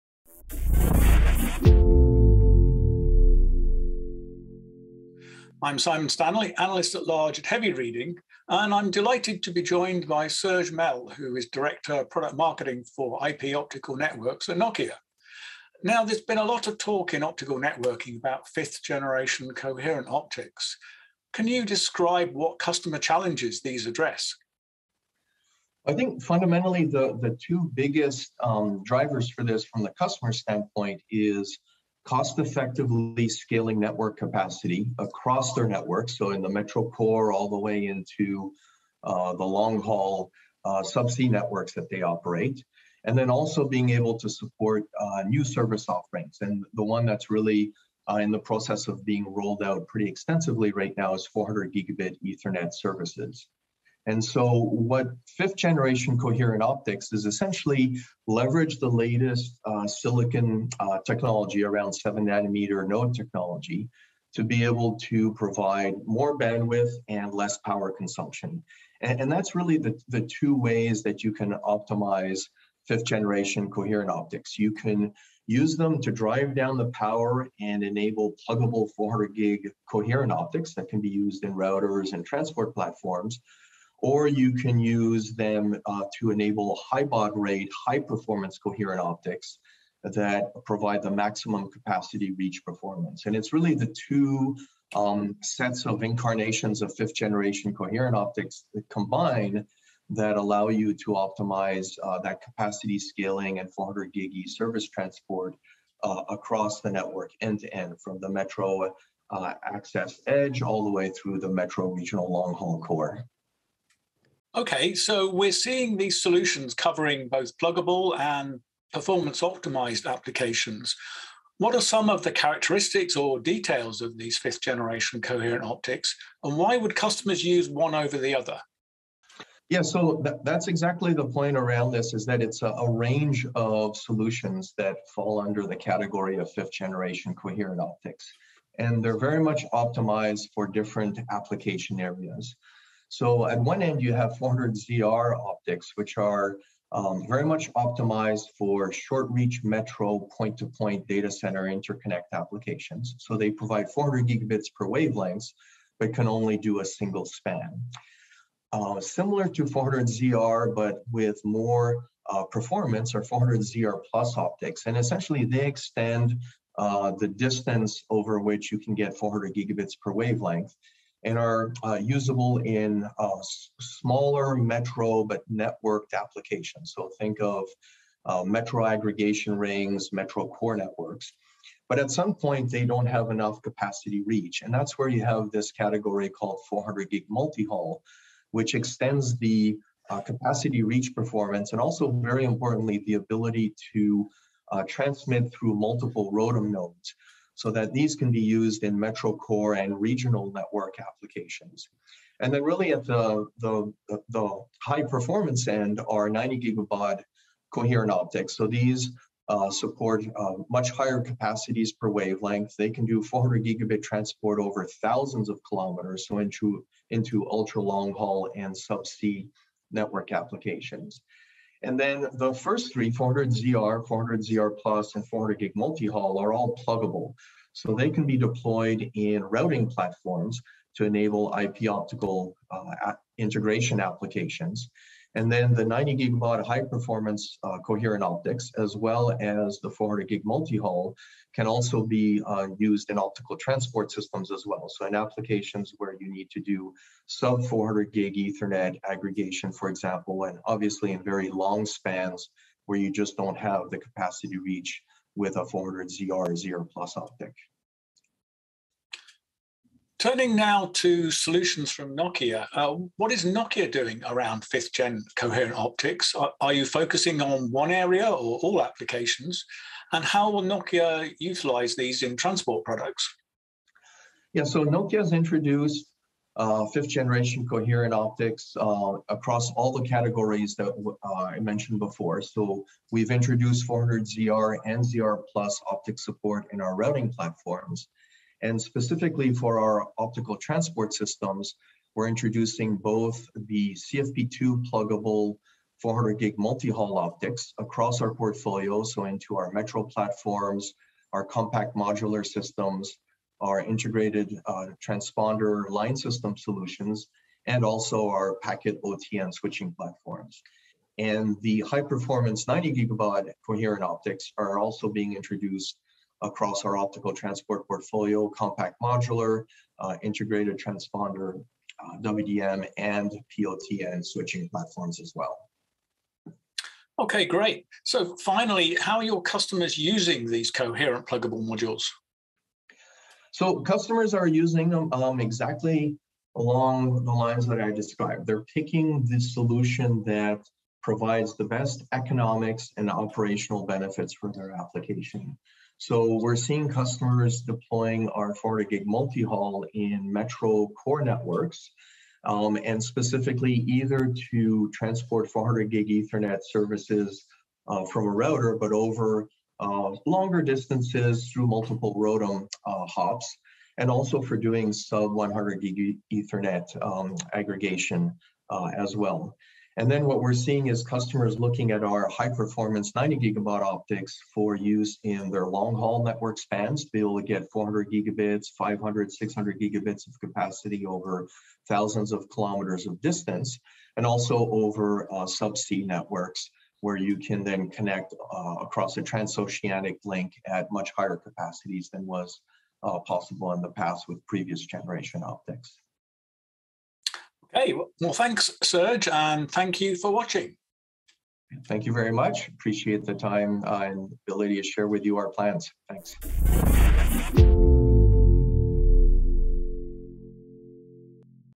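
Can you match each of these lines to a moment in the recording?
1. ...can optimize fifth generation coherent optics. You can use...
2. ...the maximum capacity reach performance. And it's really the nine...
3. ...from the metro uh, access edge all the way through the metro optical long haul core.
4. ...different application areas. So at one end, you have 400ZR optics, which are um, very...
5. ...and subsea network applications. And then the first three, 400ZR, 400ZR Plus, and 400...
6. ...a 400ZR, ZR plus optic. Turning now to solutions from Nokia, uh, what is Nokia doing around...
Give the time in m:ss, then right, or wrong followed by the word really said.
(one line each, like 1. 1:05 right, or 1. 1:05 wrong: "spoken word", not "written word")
1. 1:11 right
2. 1:31 wrong: "two", not "nine"
3. 1:48 wrong: "regional", not "optical"
4. 2:20 right
5. 3:38 right
6. 4:15 right.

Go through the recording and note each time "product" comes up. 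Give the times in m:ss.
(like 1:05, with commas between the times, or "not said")
0:12, 4:32.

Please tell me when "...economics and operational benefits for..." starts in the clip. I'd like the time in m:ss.
5:42.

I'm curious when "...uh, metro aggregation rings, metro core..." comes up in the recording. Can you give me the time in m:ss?
2:58.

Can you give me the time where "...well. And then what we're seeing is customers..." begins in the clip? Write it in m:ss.
6:09.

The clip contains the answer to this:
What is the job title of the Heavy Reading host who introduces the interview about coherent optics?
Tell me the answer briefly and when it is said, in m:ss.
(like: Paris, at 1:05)
Analyst at large, at 0:06.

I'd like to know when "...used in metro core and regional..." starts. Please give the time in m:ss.
3:18.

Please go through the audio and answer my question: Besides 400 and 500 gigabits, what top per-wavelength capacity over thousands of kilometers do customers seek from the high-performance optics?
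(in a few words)
600 gigabits.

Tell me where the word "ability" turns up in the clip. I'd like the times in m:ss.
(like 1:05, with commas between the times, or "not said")
3:13, 6:44.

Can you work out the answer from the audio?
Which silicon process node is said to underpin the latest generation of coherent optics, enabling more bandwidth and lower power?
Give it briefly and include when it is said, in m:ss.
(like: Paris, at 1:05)
7 nanometer, at 1:01.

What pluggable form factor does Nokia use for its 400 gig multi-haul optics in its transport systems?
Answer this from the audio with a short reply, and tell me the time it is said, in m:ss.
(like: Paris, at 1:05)
CFP2, at 4:53.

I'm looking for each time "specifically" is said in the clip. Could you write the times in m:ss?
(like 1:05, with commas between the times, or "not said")
4:48, 5:53.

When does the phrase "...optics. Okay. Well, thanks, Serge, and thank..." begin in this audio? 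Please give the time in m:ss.
6:35.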